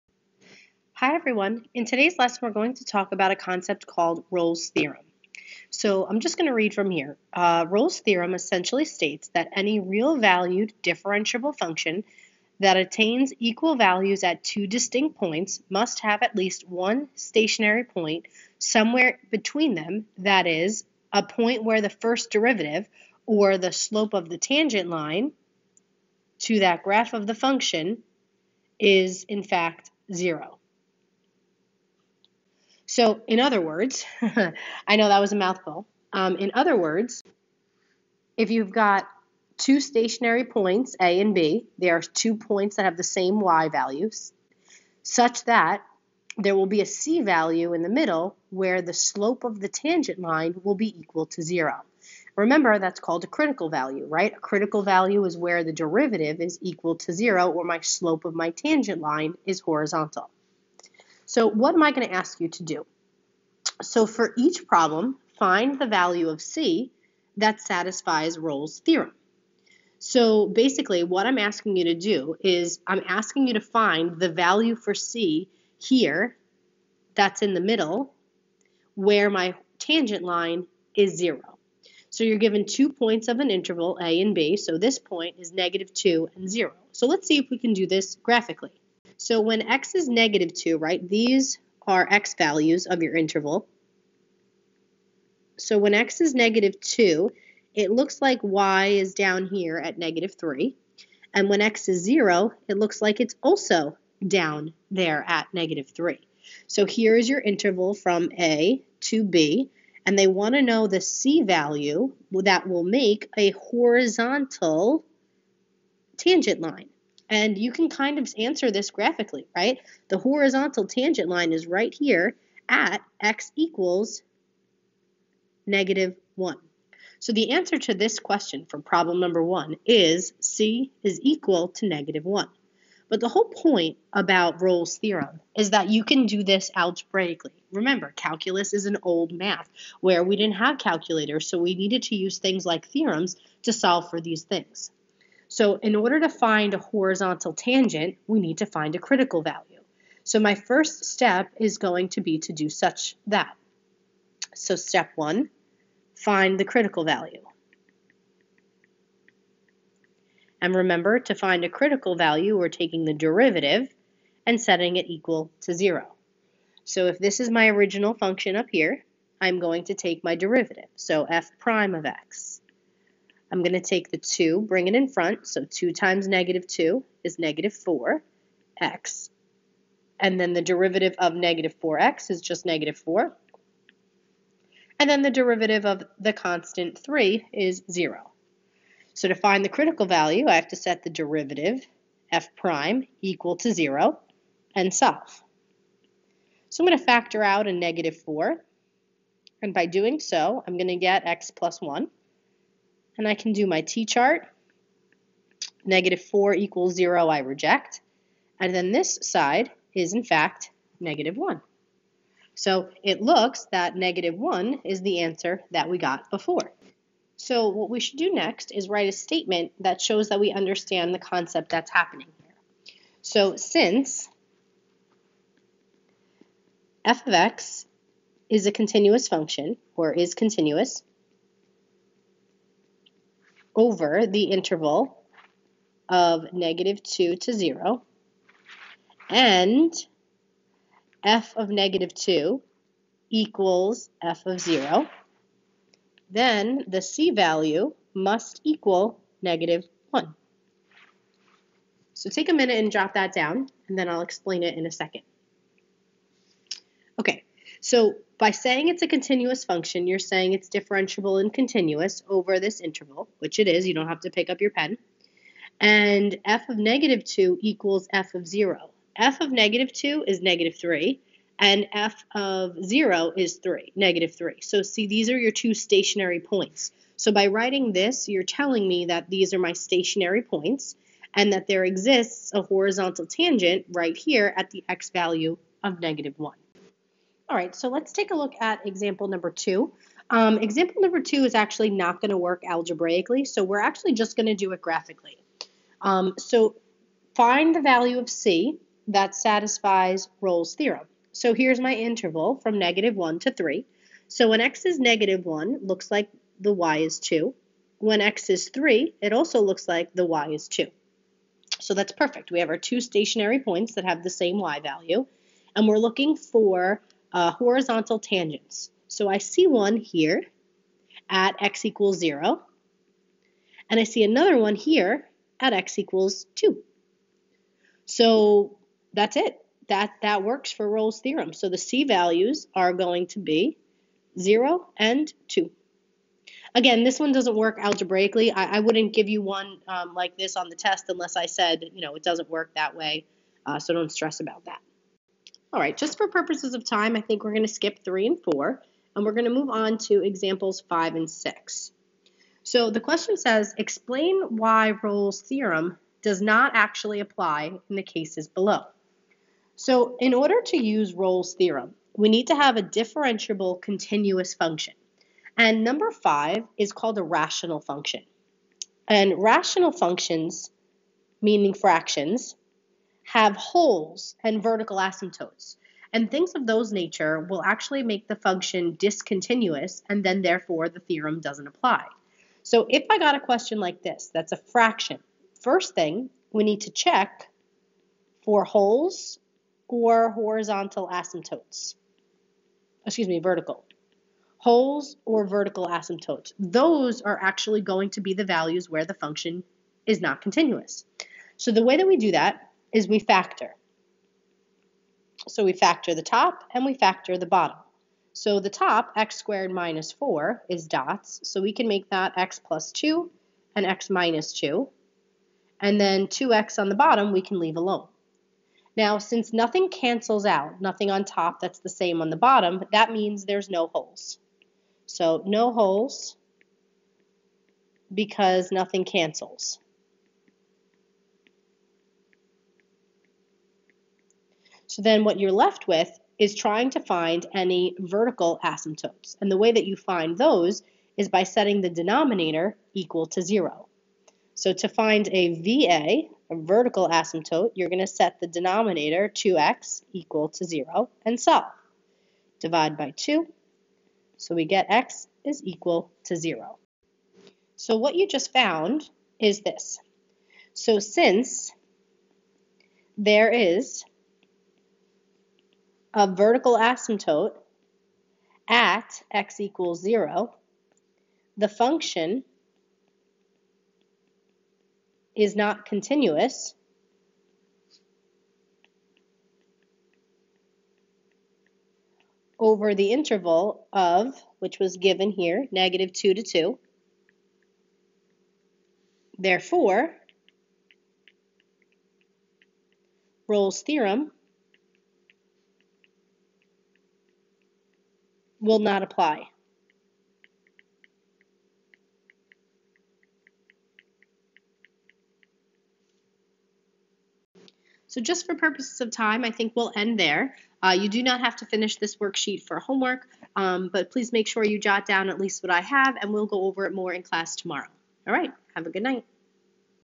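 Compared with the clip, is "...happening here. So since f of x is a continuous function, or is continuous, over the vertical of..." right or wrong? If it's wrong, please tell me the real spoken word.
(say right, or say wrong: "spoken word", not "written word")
wrong: "interval", not "vertical".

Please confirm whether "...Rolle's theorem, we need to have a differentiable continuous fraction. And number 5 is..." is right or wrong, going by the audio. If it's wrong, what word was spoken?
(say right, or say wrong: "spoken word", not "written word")
wrong: "function", not "fraction".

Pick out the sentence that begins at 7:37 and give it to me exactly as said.
So what you just found is this.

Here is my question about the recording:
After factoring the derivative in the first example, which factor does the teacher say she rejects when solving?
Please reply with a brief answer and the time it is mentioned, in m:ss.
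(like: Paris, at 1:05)
-4, at 3:25.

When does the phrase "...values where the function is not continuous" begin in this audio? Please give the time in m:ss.
6:38.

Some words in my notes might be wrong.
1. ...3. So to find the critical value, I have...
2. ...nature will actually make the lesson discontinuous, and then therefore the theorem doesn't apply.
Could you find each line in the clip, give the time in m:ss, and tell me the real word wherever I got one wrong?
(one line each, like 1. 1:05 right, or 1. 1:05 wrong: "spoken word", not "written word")
1. 3:07 wrong: "0", not "3"
2. 6:16 wrong: "function", not "lesson".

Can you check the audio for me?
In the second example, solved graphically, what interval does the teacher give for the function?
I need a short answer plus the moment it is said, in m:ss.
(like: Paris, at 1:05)
-1 to 3, at 5:02.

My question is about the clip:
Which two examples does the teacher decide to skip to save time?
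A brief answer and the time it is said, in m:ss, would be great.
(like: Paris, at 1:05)
3 and 4, at 5:48.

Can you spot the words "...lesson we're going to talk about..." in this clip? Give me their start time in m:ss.
0:02.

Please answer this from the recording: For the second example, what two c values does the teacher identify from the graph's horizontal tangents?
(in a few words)
0 and 2.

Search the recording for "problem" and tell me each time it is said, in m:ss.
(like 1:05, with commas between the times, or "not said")
1:04, 2:08.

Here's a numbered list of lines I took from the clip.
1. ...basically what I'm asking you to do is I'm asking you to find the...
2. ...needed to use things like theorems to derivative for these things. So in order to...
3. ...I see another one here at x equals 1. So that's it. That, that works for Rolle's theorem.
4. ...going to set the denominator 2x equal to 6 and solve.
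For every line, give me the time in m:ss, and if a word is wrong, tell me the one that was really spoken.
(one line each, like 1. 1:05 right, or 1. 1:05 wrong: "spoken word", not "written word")
1. 1:10 right
2. 2:21 wrong: "solve", not "derivative"
3. 5:23 wrong: "2", not "1"
4. 7:27 wrong: "0", not "6".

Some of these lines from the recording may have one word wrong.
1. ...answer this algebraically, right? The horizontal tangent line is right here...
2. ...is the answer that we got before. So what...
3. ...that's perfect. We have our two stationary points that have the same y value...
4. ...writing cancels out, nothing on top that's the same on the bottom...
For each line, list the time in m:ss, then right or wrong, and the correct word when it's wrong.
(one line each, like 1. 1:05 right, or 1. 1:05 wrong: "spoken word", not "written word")
1. 1:58 wrong: "graphically", not "algebraically"
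2. 3:34 right
3. 5:11 right
4. 6:59 wrong: "nothing", not "writing".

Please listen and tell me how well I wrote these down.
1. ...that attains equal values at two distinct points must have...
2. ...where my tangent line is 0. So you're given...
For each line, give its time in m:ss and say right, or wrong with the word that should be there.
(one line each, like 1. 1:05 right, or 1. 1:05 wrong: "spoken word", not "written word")
1. 0:12 right
2. 1:18 right.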